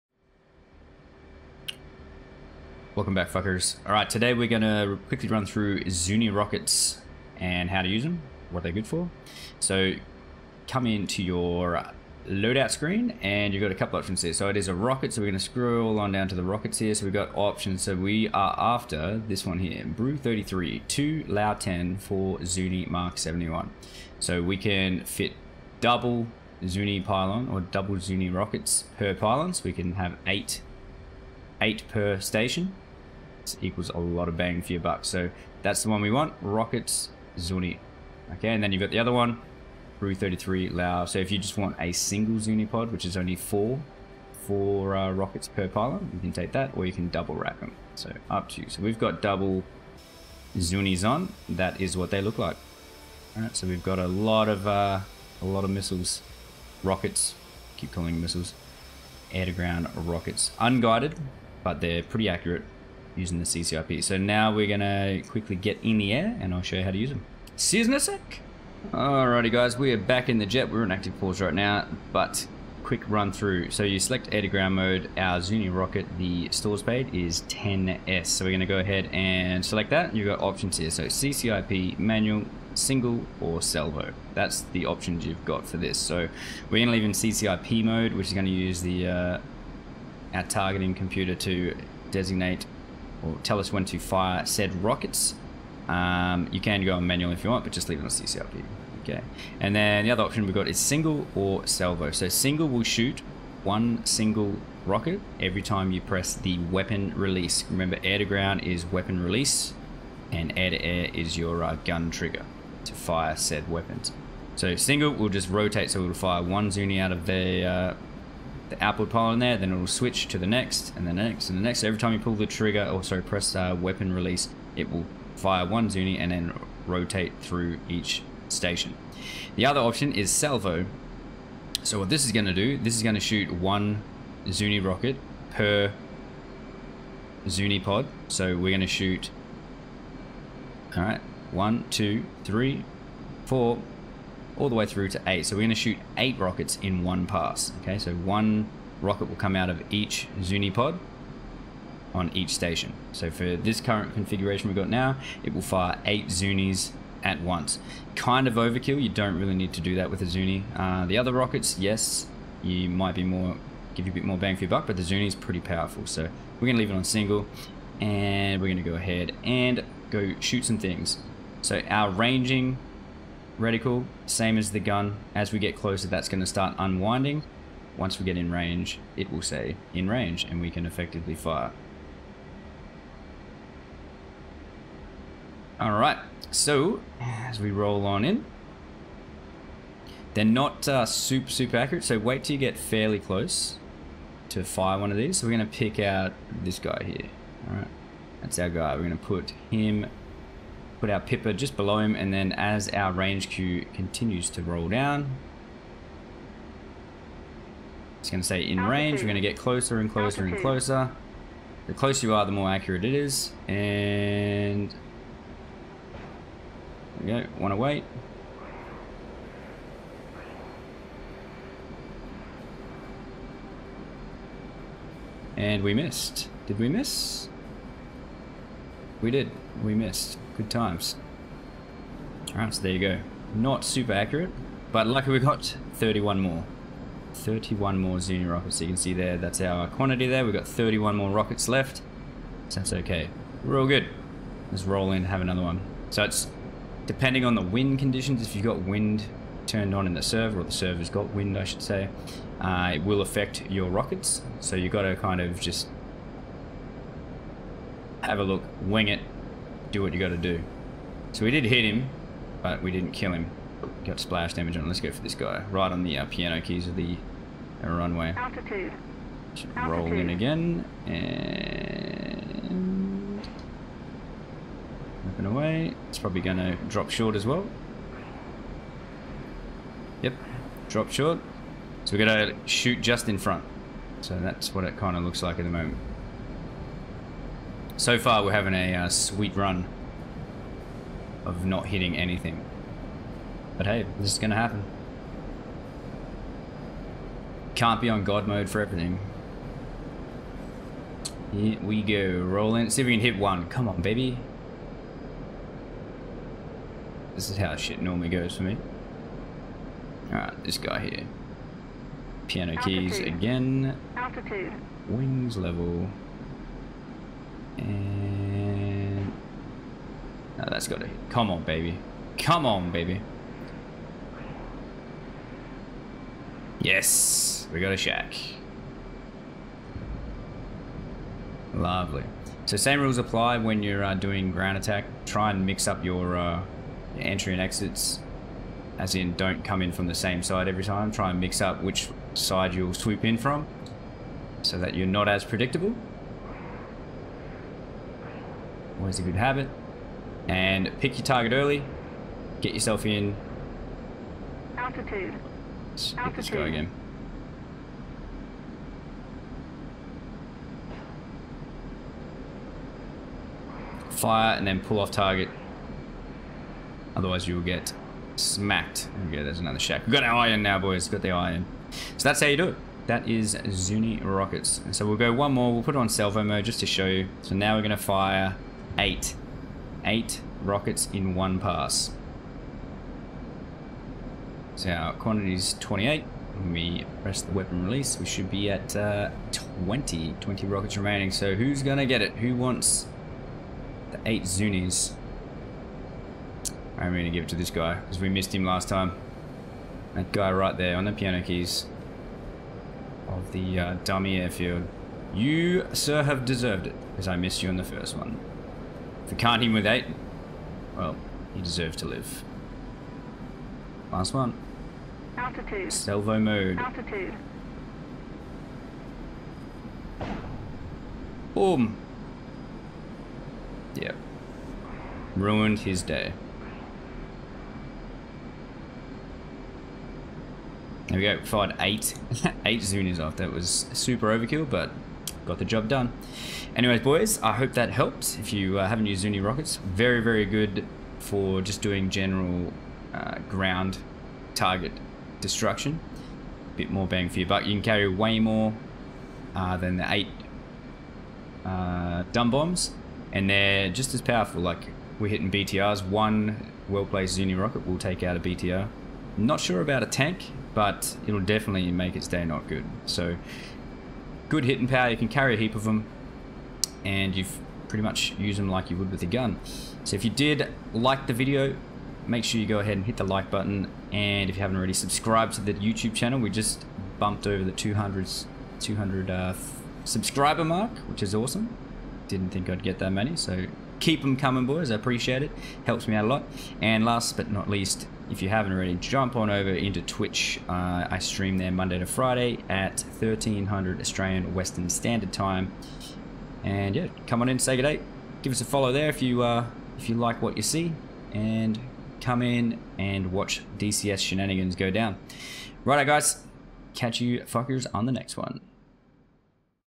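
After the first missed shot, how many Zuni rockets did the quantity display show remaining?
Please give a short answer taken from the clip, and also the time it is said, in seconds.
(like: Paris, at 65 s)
31, at 237 s.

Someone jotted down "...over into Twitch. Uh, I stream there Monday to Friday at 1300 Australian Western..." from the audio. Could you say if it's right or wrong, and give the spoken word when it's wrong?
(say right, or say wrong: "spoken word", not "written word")
right.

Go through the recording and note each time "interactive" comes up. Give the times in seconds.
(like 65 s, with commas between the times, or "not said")
not said.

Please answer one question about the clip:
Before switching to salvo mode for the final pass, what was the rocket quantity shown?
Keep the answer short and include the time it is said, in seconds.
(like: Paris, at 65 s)
28, at 384 s.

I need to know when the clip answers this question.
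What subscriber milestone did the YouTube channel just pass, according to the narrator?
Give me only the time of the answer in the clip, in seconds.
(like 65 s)
478 s.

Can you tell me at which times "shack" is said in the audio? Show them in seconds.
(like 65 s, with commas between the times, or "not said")
327 s, 369 s.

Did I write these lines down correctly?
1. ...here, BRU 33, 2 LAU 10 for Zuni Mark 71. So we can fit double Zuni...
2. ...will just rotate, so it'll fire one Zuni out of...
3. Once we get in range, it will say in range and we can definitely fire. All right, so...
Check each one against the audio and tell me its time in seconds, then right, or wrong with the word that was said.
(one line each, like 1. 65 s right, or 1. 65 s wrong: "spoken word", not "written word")
1. 19 s right
2. 115 s right
3. 177 s wrong: "effectively", not "definitely".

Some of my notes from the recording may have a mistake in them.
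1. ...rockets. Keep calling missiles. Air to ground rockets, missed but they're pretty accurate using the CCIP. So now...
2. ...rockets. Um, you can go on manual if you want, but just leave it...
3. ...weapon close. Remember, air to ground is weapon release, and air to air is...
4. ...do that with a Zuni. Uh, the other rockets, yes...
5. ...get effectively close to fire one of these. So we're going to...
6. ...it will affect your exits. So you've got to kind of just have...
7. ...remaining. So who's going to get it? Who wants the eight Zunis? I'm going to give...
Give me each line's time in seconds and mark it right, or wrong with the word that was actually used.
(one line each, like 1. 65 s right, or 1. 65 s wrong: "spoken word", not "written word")
1. 56 s wrong: "unguided", not "missed"
2. 94 s right
3. 106 s wrong: "release", not "close"
4. 159 s right
5. 192 s wrong: "fairly", not "effectively"
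6. 252 s wrong: "rockets", not "exits"
7. 390 s right.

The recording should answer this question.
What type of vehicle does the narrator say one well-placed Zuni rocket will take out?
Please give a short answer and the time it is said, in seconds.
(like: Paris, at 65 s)
BTR, at 456 s.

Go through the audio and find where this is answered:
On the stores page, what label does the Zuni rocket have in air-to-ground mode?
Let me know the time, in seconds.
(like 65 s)
77 s.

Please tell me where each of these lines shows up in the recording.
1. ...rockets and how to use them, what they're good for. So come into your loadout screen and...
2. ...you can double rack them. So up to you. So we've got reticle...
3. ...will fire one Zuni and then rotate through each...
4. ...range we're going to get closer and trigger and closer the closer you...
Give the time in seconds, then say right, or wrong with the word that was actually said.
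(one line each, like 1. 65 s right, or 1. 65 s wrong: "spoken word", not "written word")
1. 6 s right
2. 46 s wrong: "double", not "reticle"
3. 124 s right
4. 208 s wrong: "closer", not "trigger".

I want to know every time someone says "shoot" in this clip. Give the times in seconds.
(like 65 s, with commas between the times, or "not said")
102 s, 133 s, 138 s, 145 s, 170 s, 282 s.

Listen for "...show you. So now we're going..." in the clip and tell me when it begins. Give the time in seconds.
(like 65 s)
376 s.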